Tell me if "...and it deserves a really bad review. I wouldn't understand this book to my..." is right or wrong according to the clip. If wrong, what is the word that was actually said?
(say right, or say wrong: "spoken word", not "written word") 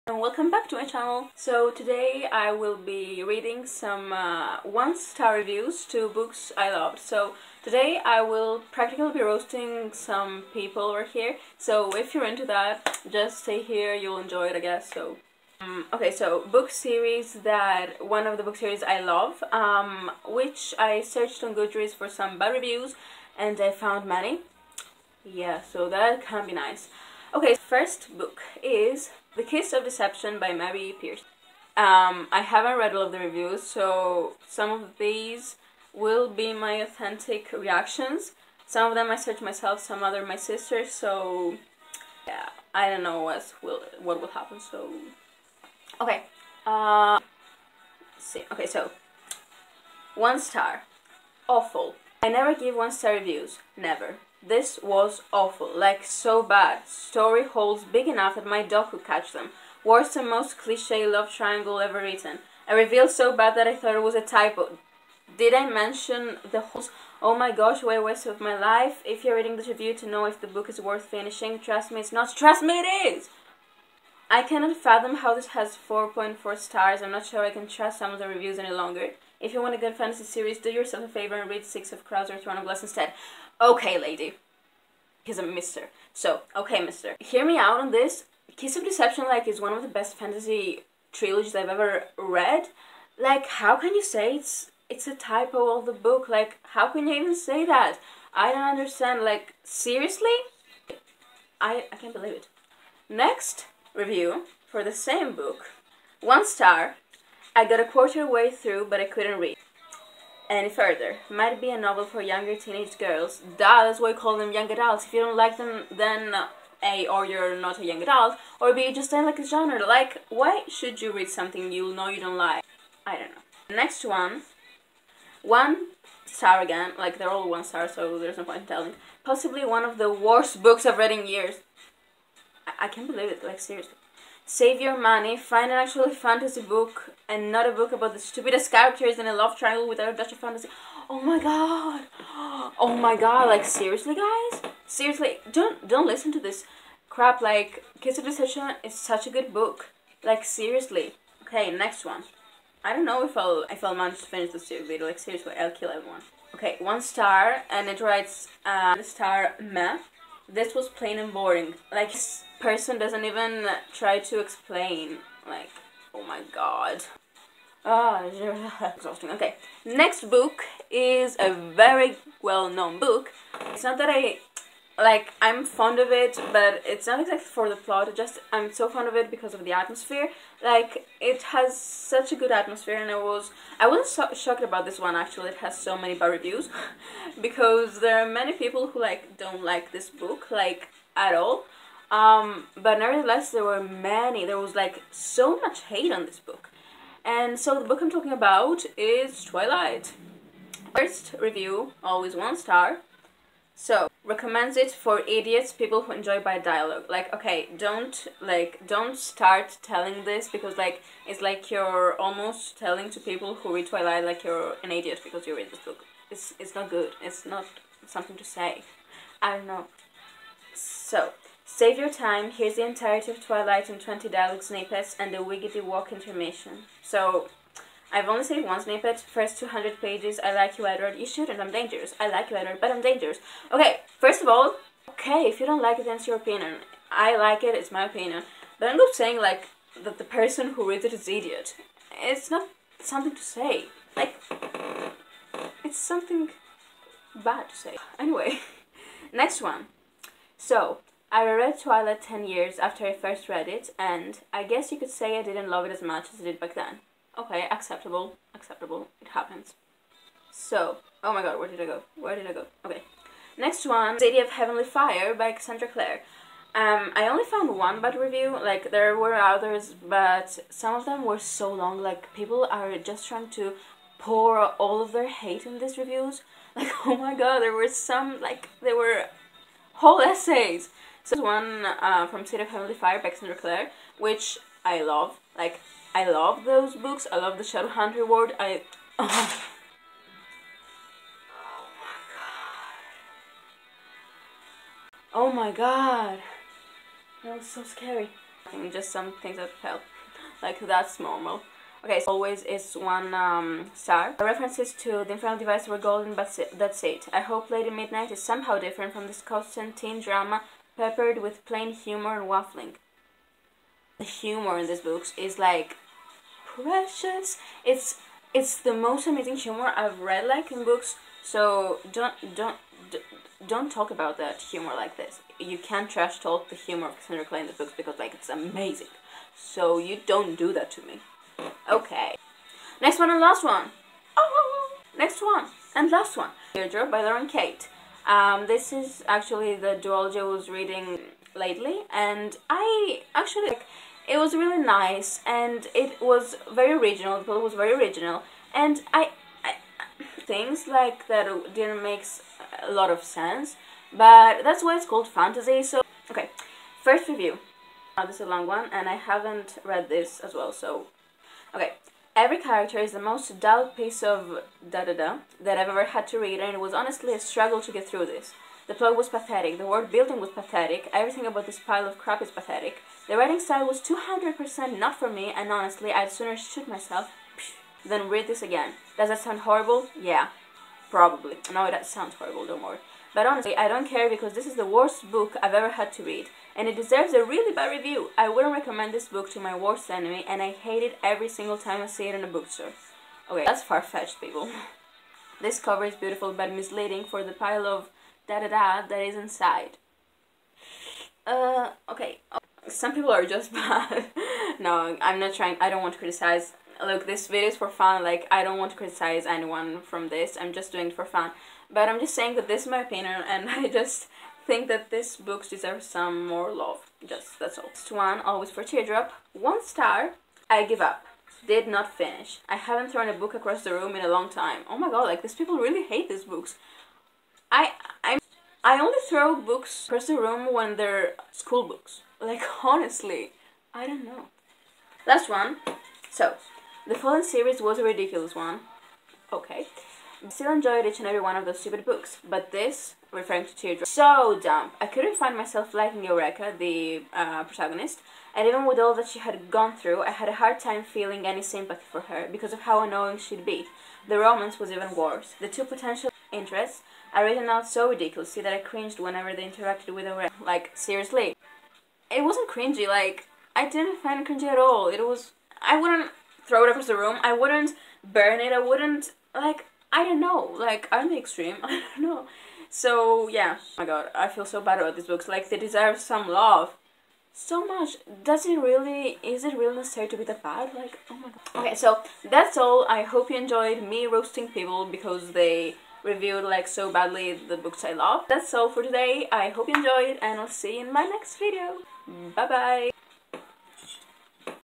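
wrong: "recommend", not "understand".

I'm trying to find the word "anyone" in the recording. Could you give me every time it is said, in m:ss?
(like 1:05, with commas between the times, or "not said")
6:49.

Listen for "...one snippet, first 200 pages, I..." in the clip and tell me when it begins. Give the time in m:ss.
3:48.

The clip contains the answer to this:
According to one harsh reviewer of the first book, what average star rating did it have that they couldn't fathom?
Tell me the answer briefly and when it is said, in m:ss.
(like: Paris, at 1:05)
4.4, at 1:15.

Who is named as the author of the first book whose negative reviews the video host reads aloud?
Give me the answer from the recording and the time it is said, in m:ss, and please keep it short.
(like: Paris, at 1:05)
Mary Pearson, at 0:30.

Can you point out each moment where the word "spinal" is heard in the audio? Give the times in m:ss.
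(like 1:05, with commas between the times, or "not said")
not said.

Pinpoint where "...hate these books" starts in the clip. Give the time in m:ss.
7:06.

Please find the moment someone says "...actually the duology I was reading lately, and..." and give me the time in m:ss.
5:39.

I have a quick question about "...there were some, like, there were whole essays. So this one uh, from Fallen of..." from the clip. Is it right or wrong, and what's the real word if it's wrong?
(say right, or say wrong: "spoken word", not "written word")
wrong: "City", not "Fallen".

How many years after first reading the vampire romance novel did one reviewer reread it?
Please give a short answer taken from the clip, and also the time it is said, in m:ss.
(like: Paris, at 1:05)
10, at 4:12.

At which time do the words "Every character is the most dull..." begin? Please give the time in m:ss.
6:02.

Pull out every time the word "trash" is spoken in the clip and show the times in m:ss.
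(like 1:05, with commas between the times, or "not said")
5:26.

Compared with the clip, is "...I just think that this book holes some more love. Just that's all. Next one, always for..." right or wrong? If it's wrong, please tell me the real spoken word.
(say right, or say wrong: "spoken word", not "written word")
wrong: "deserves", not "holes".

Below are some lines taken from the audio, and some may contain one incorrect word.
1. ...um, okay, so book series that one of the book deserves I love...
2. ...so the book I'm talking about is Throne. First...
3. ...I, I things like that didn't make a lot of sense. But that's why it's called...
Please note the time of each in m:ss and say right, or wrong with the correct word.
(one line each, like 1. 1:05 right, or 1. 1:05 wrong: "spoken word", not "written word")
1. 0:15 wrong: "series", not "deserves"
2. 3:17 wrong: "Twilight", not "Throne"
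3. 5:49 right.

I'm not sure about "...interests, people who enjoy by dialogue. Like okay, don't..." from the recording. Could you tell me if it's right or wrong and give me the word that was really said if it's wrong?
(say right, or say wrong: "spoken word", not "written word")
wrong: "idiots", not "interests".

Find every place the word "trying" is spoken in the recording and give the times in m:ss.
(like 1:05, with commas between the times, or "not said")
4:33, 6:45.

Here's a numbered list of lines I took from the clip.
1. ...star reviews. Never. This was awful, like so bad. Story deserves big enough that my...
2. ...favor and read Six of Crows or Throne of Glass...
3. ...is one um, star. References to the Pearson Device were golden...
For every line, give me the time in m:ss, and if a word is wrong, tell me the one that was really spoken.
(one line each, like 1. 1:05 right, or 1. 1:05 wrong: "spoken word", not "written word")
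1. 0:52 wrong: "holes", not "deserves"
2. 1:21 right
3. 5:02 wrong: "Infernal", not "Pearson".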